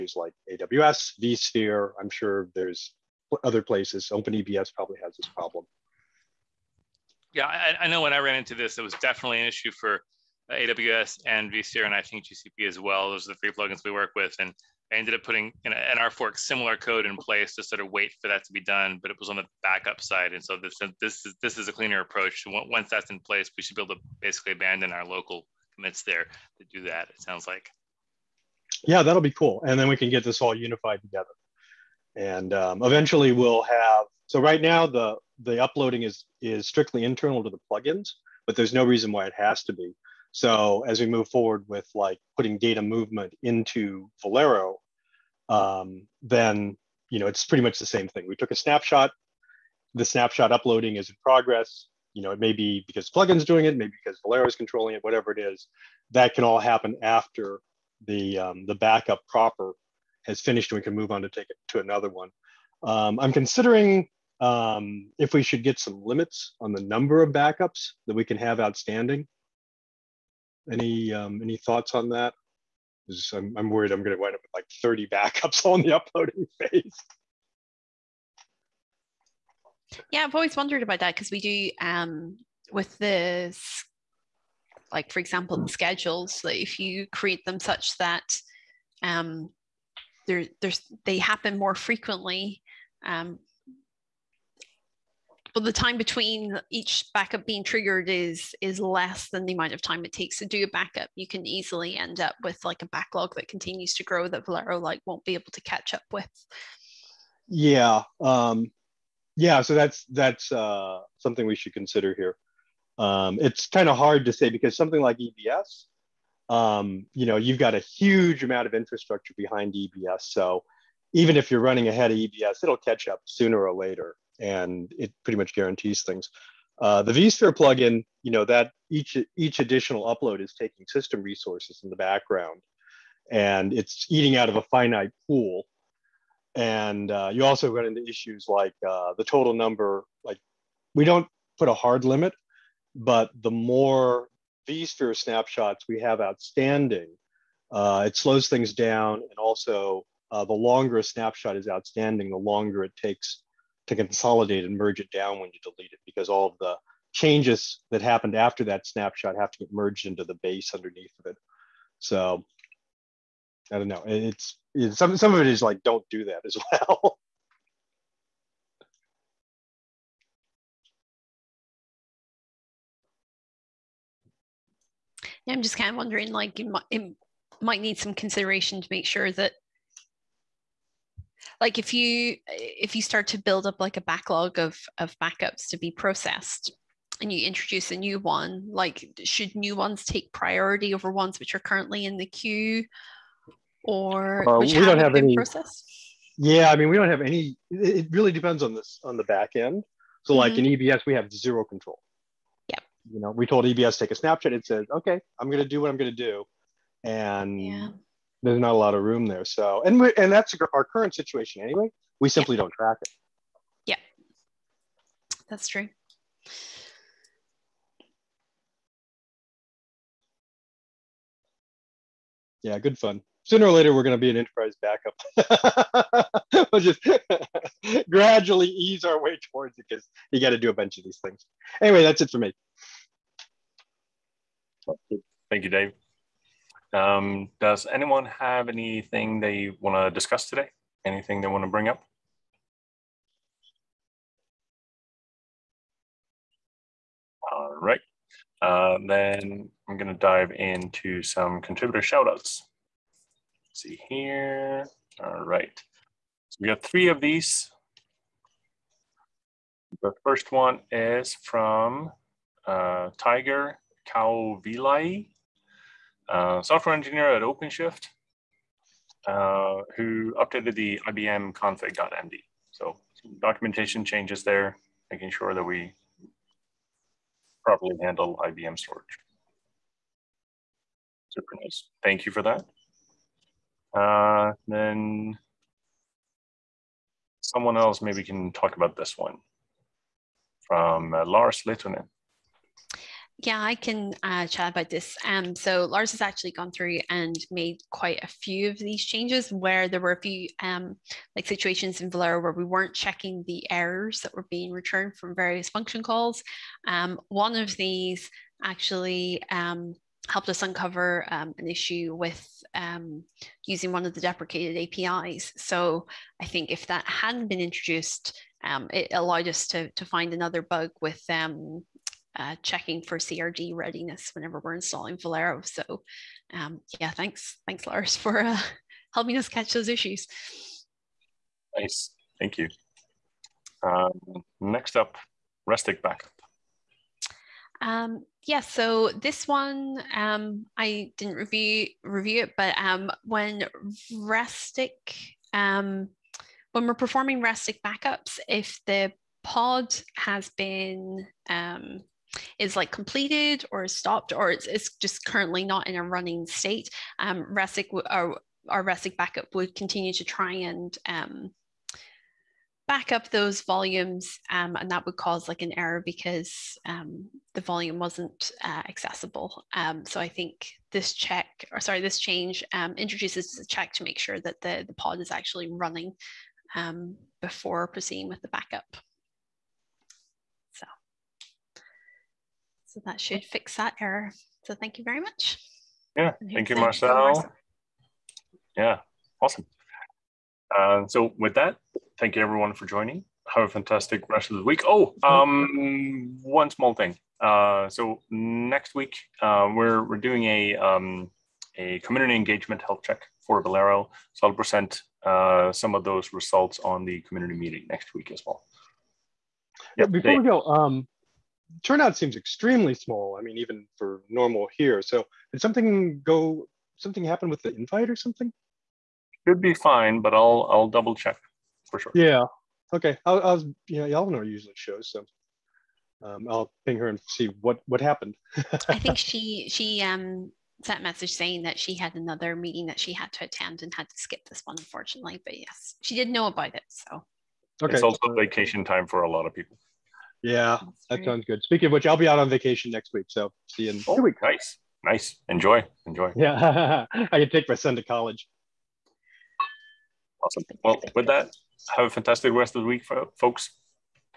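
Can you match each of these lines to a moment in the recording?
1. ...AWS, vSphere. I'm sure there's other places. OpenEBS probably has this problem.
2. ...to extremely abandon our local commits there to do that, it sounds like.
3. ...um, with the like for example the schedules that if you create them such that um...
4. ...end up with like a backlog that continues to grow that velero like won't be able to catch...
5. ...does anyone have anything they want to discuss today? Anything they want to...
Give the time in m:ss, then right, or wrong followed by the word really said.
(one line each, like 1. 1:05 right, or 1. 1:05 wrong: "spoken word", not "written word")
1. 0:00 right
2. 0:23 wrong: "basically", not "extremely"
3. 1:21 right
4. 1:41 right
5. 3:57 right.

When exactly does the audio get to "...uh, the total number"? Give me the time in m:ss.
2:18.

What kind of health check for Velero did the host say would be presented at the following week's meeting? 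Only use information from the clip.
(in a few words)
community engagement.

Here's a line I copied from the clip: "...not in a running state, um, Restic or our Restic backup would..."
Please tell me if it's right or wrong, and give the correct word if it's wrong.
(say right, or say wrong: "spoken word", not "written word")
right.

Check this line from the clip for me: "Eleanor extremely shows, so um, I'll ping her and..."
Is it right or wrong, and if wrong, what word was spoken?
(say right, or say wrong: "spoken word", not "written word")
wrong: "usually", not "extremely".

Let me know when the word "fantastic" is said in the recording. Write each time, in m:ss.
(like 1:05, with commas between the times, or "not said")
6:33, 7:32.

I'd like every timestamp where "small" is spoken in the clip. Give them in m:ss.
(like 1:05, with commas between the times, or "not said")
6:36, 6:52.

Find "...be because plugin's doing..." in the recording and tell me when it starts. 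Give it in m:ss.
0:52.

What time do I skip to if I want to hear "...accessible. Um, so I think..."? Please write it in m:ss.
6:08.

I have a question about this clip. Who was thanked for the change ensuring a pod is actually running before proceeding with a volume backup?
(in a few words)
Marcel.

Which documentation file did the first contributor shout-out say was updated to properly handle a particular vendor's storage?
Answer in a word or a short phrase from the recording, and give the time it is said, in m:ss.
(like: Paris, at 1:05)
IBM config.md, at 4:31.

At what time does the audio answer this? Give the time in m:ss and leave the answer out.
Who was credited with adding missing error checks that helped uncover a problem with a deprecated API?
4:51.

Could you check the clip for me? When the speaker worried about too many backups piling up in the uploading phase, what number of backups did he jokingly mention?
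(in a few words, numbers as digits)
30.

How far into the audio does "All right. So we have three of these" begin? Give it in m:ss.
4:15.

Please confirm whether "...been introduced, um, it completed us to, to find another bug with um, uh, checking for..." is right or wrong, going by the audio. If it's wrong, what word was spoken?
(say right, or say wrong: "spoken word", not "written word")
wrong: "allowed", not "completed".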